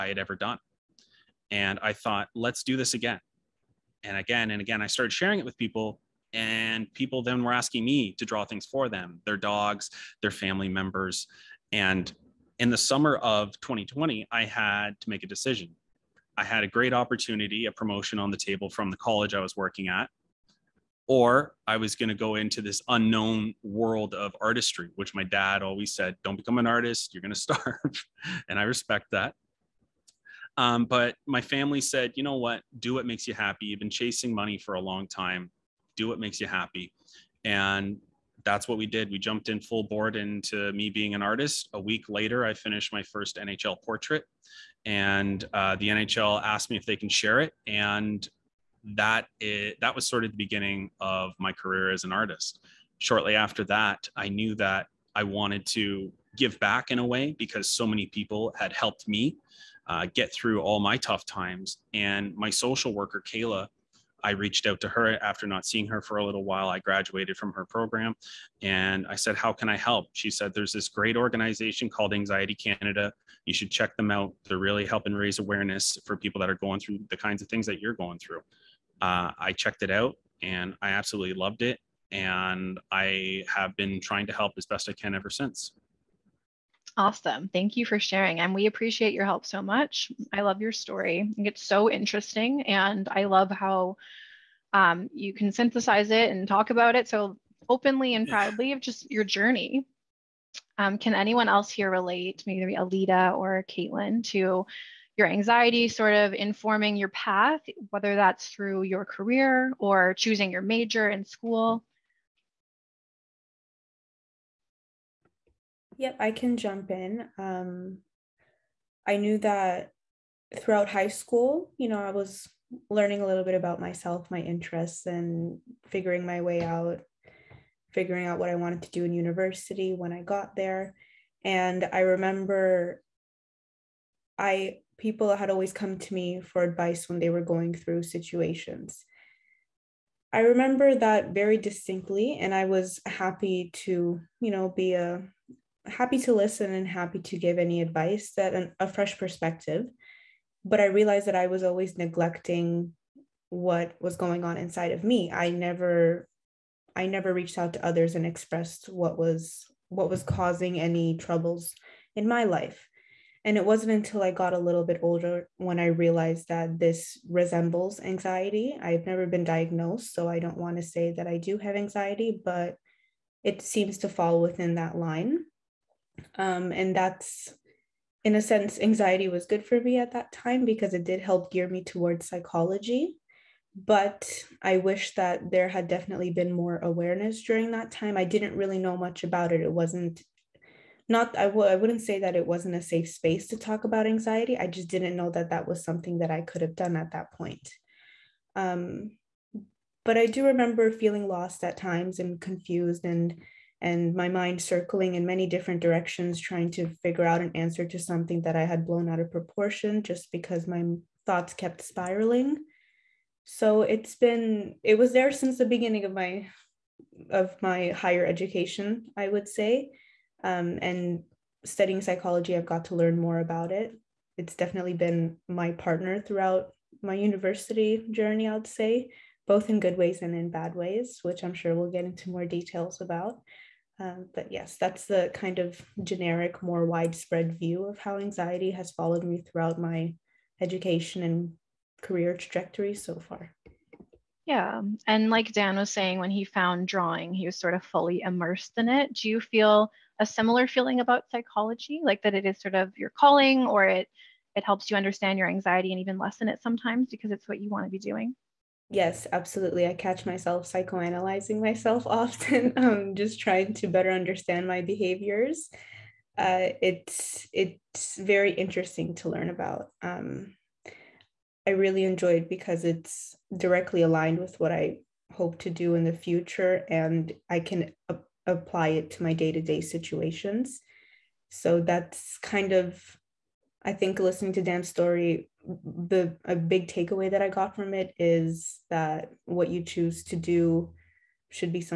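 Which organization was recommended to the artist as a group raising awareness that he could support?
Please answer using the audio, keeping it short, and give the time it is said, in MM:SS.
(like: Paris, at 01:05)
Anxiety Canada, at 01:12.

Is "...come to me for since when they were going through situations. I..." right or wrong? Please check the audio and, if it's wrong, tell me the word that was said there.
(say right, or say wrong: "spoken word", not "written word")
wrong: "advice", not "since".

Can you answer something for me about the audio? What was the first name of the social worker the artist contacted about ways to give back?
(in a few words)
Kayla.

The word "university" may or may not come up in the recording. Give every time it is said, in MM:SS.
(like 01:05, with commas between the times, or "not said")
02:09, 03:47.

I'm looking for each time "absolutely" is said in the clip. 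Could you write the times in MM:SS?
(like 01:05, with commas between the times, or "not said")
01:20, 04:19.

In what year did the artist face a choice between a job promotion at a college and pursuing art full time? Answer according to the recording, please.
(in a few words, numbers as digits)
2020.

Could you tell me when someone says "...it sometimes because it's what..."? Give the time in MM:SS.
04:16.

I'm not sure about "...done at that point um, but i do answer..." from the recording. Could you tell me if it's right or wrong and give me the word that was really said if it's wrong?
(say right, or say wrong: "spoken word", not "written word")
wrong: "remember", not "answer".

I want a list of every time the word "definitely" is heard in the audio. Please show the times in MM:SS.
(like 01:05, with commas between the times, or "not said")
03:05, 03:44.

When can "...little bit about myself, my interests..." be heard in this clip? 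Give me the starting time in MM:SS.
02:03.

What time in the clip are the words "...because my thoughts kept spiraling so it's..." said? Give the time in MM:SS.
03:30.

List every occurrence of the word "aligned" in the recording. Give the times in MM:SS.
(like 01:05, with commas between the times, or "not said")
04:34.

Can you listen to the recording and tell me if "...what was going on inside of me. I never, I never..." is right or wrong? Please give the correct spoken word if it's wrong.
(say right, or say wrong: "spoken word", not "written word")
right.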